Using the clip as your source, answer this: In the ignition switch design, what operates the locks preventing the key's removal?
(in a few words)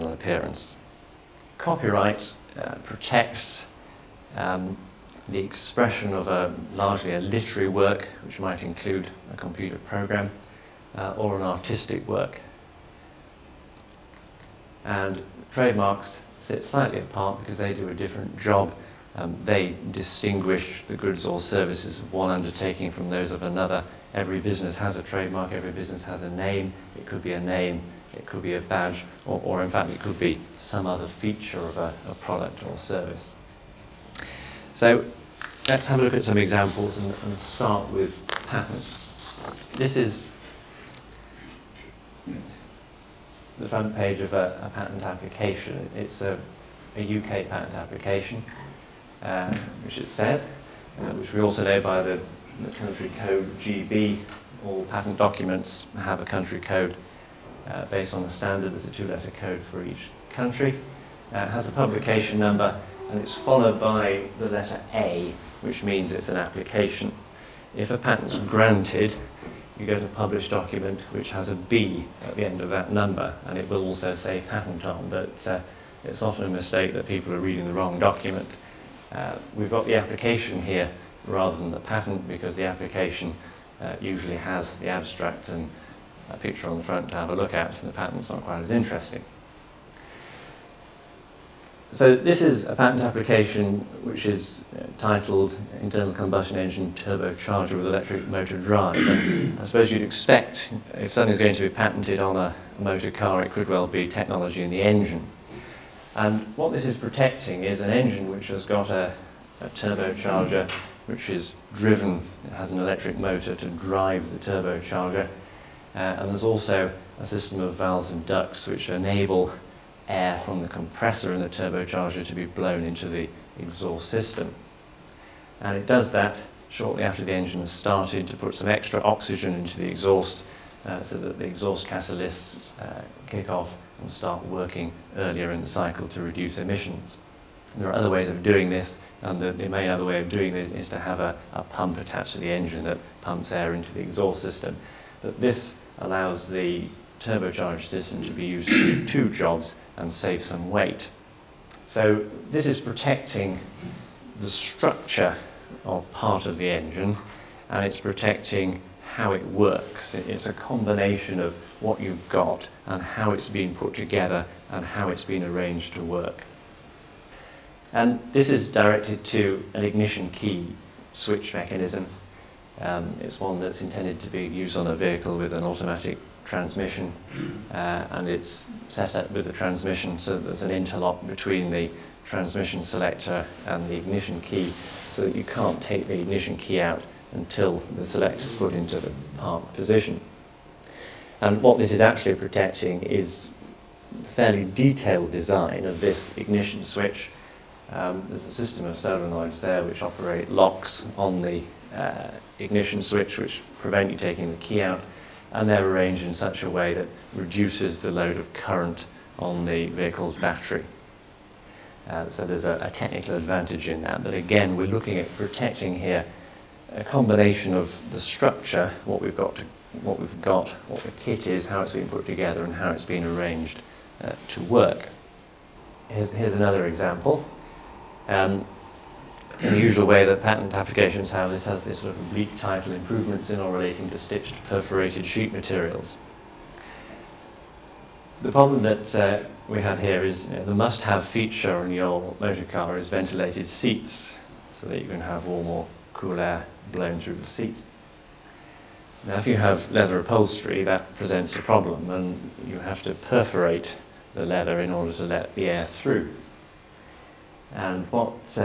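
Solenoids.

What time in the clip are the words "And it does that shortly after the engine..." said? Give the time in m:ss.
2:05.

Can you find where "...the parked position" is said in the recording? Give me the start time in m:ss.
3:08.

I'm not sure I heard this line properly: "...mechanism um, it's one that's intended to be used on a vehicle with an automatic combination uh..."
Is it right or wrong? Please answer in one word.
wrong.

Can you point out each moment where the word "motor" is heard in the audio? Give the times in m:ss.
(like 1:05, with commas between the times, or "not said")
1:38, 1:42, 1:53, 4:02.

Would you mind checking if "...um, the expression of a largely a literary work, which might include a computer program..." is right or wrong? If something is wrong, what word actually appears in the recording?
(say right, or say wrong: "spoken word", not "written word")
right.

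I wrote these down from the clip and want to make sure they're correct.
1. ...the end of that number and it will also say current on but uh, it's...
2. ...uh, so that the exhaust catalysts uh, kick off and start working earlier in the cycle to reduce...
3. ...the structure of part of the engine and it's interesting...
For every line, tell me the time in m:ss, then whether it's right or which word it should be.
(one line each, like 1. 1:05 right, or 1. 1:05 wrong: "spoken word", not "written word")
1. 1:12 wrong: "patent", not "current"
2. 2:10 right
3. 2:34 wrong: "protecting", not "interesting".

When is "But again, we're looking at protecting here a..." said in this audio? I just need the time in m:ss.
3:34.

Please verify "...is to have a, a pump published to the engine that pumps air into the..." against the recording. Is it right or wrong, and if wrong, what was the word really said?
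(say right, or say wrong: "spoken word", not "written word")
wrong: "attached", not "published".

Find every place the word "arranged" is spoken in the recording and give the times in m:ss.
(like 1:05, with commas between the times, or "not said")
2:45, 3:25, 3:43.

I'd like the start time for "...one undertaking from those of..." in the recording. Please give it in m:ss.
0:22.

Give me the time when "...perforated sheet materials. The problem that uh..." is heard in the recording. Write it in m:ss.
3:54.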